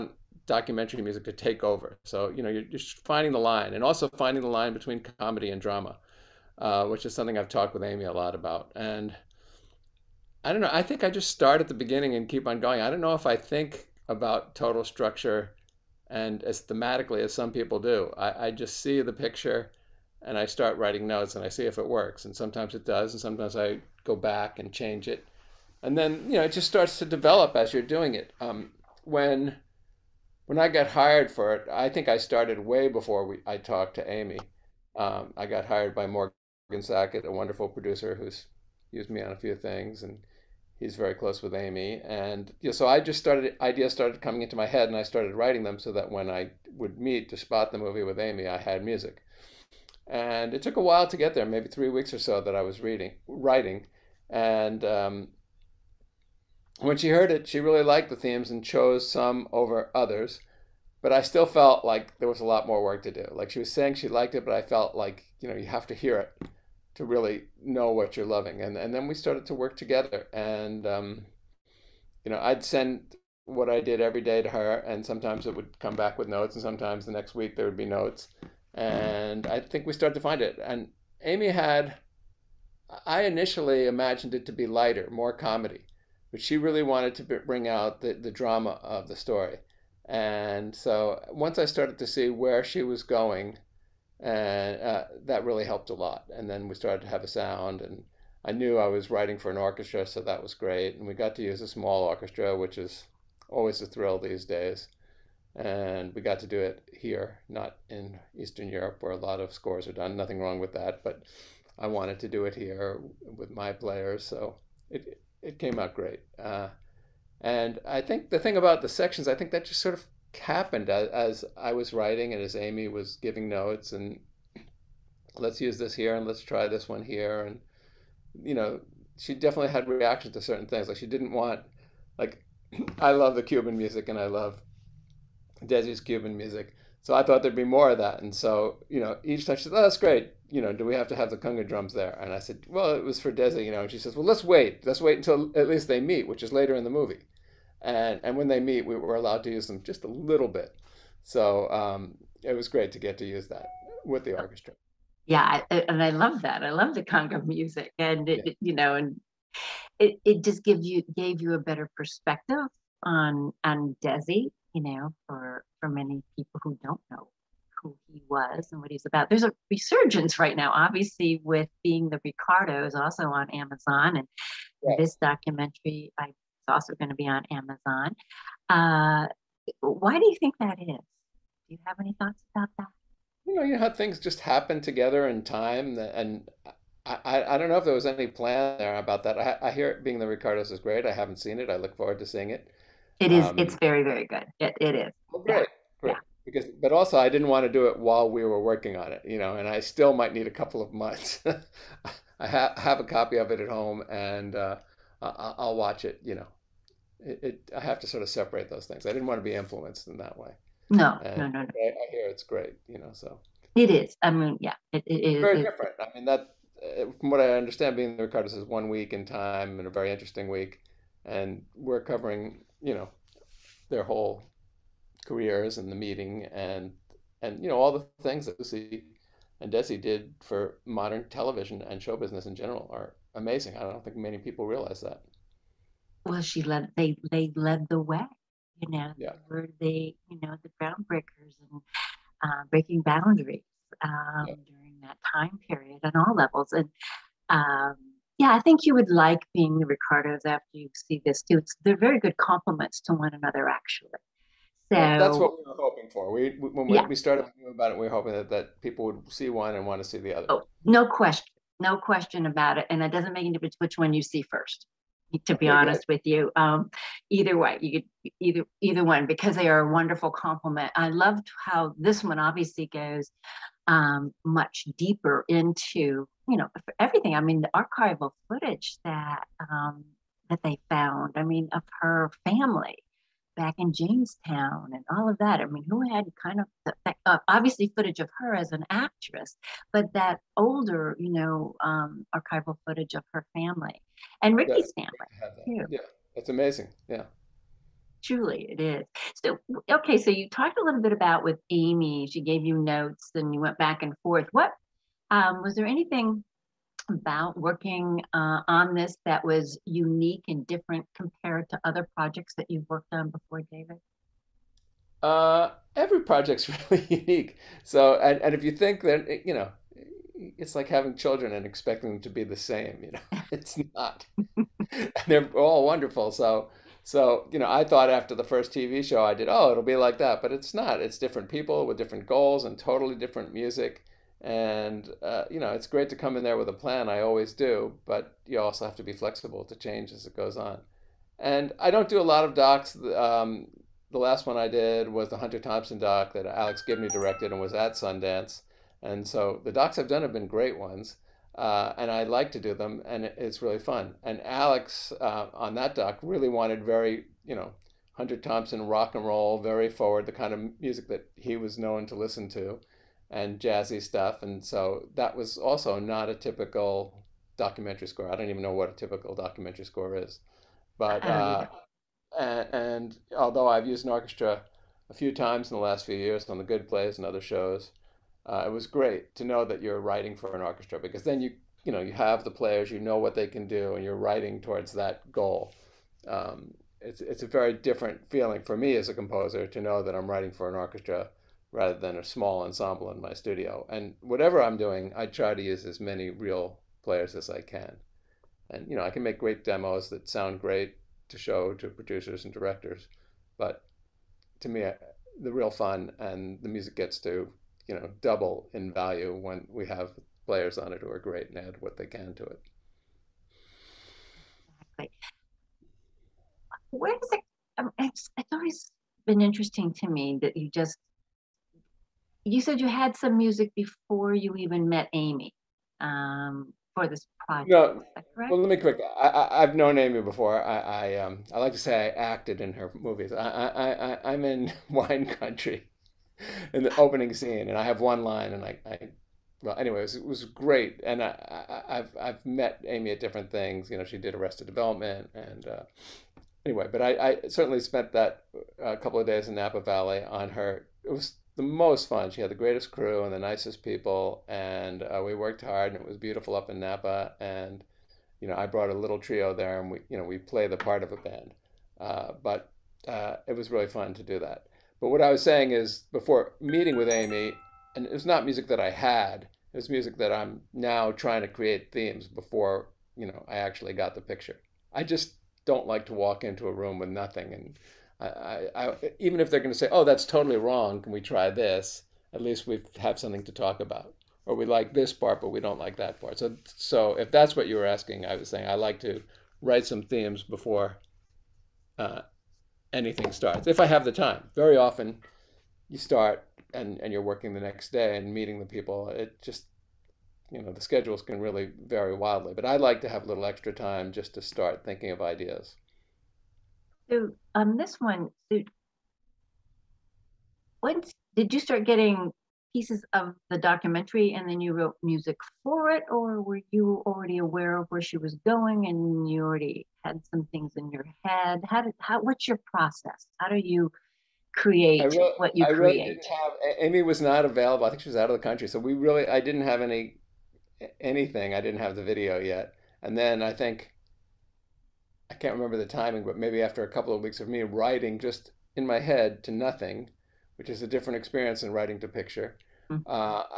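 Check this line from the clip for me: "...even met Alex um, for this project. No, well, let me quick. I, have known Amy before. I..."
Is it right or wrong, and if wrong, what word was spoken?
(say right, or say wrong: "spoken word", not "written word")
wrong: "Amy", not "Alex".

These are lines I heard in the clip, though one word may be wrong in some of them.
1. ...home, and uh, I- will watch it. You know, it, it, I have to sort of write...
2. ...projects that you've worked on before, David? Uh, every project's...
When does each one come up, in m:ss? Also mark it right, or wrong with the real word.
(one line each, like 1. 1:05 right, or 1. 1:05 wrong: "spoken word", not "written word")
1. 3:23 wrong: "separate", not "write"
2. 5:12 right.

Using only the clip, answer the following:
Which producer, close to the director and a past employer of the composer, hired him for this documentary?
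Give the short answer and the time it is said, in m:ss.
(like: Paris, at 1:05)
Morgan Sackett, at 0:36.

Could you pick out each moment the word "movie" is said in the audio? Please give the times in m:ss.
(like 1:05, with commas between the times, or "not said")
0:47, 2:26, 7:12.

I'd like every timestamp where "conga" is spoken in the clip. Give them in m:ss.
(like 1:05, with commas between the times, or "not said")
2:21, 2:37.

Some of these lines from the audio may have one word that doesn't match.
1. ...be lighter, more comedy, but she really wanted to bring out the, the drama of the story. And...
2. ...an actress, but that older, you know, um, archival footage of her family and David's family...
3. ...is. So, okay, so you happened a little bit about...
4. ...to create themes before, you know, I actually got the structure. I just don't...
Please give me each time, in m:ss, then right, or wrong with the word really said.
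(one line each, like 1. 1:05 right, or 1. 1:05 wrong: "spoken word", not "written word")
1. 1:24 right
2. 4:48 wrong: "Ricky", not "David"
3. 4:58 wrong: "talked", not "happened"
4. 7:51 wrong: "picture", not "structure".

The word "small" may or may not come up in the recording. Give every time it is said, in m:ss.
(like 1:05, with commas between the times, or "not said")
1:41, 6:32.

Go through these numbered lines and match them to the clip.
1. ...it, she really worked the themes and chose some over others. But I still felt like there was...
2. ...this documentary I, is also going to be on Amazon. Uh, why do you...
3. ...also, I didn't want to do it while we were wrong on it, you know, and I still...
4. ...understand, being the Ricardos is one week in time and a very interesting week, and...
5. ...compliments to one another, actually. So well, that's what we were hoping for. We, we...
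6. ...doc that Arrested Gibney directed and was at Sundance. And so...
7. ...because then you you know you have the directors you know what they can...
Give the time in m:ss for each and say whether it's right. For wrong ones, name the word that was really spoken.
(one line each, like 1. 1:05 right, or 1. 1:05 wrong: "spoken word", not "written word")
1. 0:57 wrong: "liked", not "worked"
2. 2:54 right
3. 3:16 wrong: "working", not "wrong"
4. 3:37 right
5. 4:12 right
6. 5:45 wrong: "Alex", not "Arrested"
7. 6:20 wrong: "players", not "directors".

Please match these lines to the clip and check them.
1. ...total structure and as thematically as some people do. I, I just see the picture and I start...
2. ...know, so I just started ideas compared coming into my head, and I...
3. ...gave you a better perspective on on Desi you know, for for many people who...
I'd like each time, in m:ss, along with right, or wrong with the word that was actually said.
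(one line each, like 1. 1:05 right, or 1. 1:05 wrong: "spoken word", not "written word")
1. 0:14 right
2. 0:42 wrong: "started", not "compared"
3. 2:41 right.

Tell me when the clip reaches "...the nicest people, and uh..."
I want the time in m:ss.
7:33.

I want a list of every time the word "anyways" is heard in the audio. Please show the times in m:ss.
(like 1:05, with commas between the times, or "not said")
7:19, 7:26.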